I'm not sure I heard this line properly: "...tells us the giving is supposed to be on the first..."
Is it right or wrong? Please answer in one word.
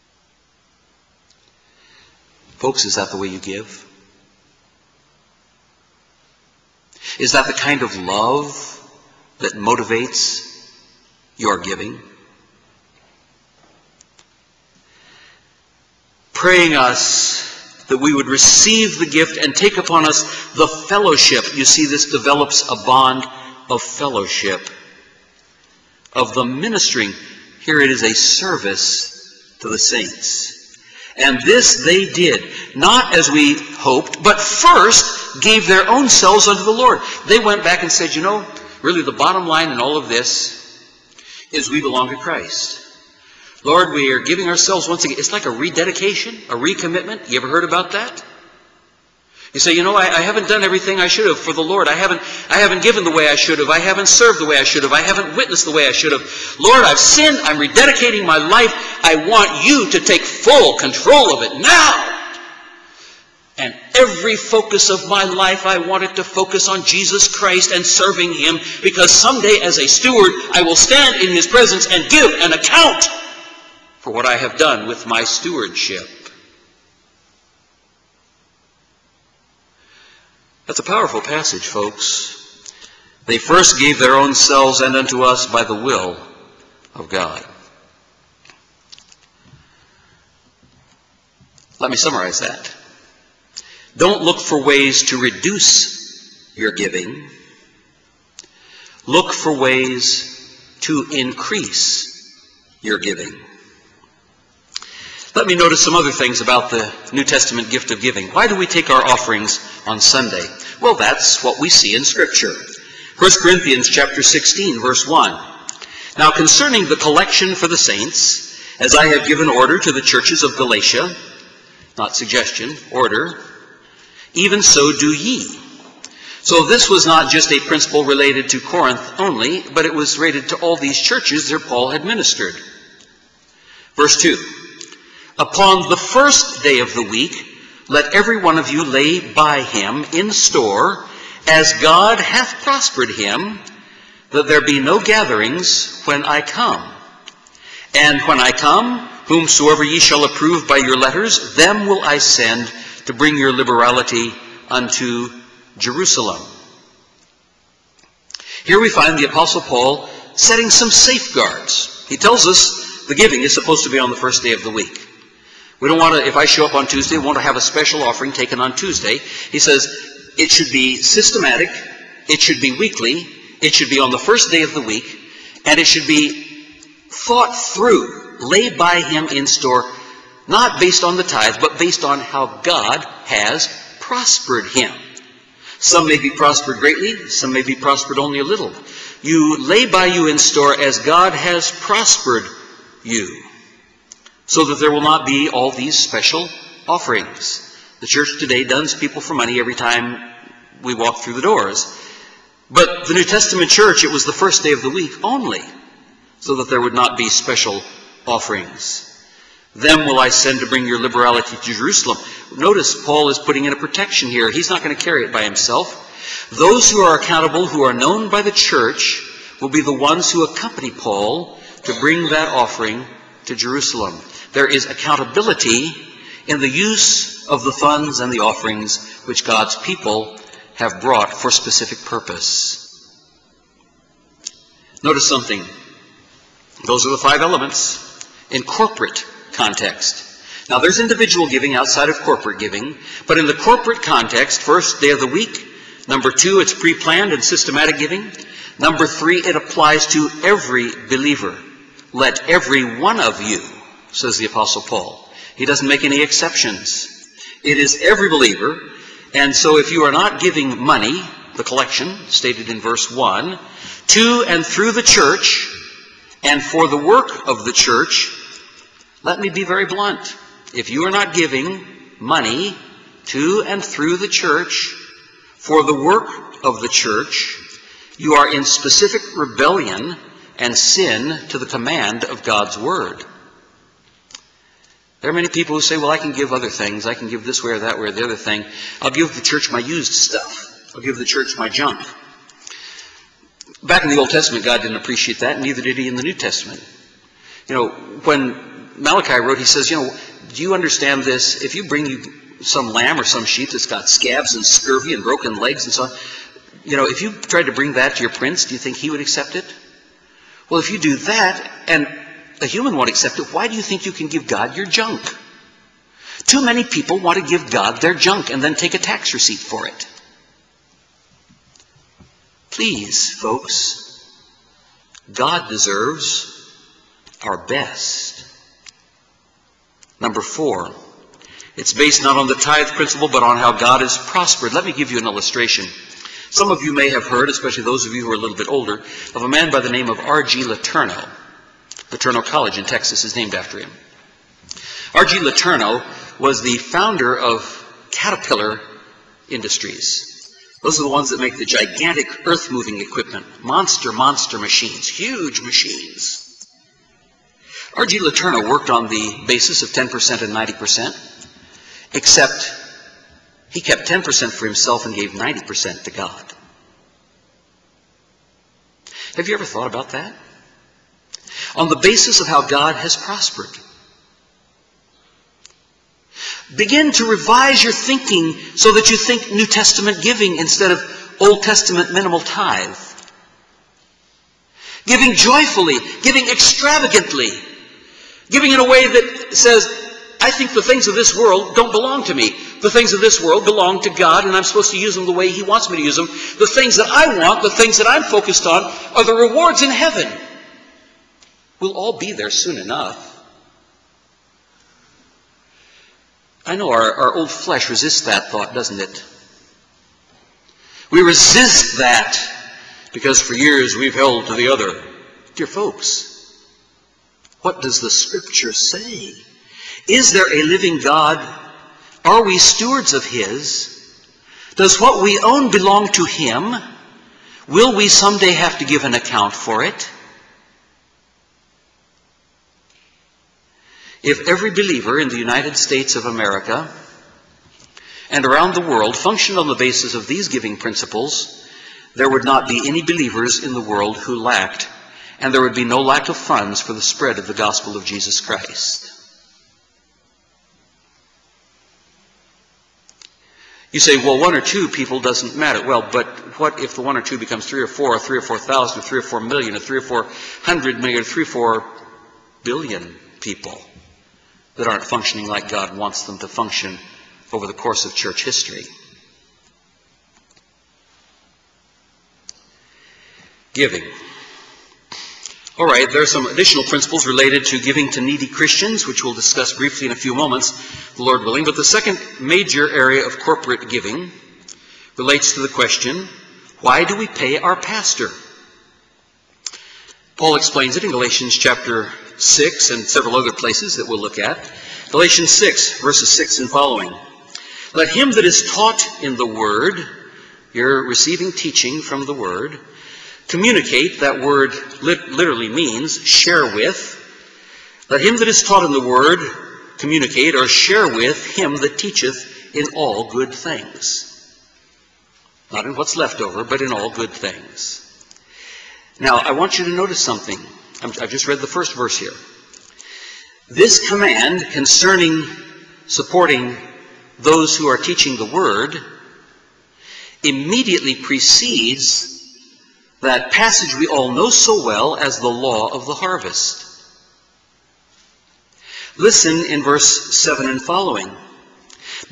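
right.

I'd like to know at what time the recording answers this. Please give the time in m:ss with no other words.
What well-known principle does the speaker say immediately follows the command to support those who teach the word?
8:55.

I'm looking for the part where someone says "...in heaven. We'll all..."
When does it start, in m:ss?
6:39.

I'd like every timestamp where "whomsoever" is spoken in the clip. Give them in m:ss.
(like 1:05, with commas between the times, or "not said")
2:29.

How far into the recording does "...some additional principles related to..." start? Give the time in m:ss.
7:56.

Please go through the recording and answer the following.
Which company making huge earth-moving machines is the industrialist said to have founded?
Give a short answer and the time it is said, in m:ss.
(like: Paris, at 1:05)
Caterpillar Industries, at 5:48.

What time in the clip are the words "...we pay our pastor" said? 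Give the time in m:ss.
8:07.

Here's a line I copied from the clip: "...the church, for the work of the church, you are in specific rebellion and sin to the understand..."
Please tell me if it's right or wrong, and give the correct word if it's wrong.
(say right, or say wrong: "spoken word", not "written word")
wrong: "command", not "understand".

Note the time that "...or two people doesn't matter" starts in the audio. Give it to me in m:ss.
7:34.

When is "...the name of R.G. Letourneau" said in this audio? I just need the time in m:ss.
5:39.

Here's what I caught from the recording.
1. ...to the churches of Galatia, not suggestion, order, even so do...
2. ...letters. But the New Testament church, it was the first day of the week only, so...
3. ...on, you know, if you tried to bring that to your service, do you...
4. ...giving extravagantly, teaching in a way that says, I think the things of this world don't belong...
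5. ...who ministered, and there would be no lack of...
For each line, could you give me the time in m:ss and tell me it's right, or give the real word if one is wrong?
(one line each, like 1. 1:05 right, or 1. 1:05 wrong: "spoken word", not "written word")
1. 1:59 right
2. 3:21 wrong: "doors", not "letters"
3. 5:06 wrong: "prince", not "service"
4. 6:26 wrong: "giving", not "teaching"
5. 7:24 wrong: "lacked", not "ministered".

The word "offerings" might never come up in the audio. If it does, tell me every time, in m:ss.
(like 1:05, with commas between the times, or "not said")
1:49, 2:48, 3:16, 3:28, 3:42, 3:48.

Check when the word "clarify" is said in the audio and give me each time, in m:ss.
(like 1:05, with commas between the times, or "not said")
not said.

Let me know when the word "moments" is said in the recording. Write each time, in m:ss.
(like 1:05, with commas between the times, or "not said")
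8:00.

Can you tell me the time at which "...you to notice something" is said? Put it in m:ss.
8:39.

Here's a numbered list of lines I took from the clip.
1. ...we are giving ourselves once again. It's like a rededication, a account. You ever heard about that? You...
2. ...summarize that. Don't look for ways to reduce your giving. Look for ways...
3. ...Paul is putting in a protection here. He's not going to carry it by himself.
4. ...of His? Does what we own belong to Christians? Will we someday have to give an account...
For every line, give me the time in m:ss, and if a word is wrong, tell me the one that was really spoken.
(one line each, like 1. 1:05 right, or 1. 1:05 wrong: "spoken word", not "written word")
1. 0:43 wrong: "recommitment", not "account"
2. 1:31 right
3. 3:33 right
4. 7:03 wrong: "Him", not "Christians".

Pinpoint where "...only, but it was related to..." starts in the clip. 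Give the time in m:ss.
2:09.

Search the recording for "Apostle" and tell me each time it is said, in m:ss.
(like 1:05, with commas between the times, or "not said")
2:39, 4:14.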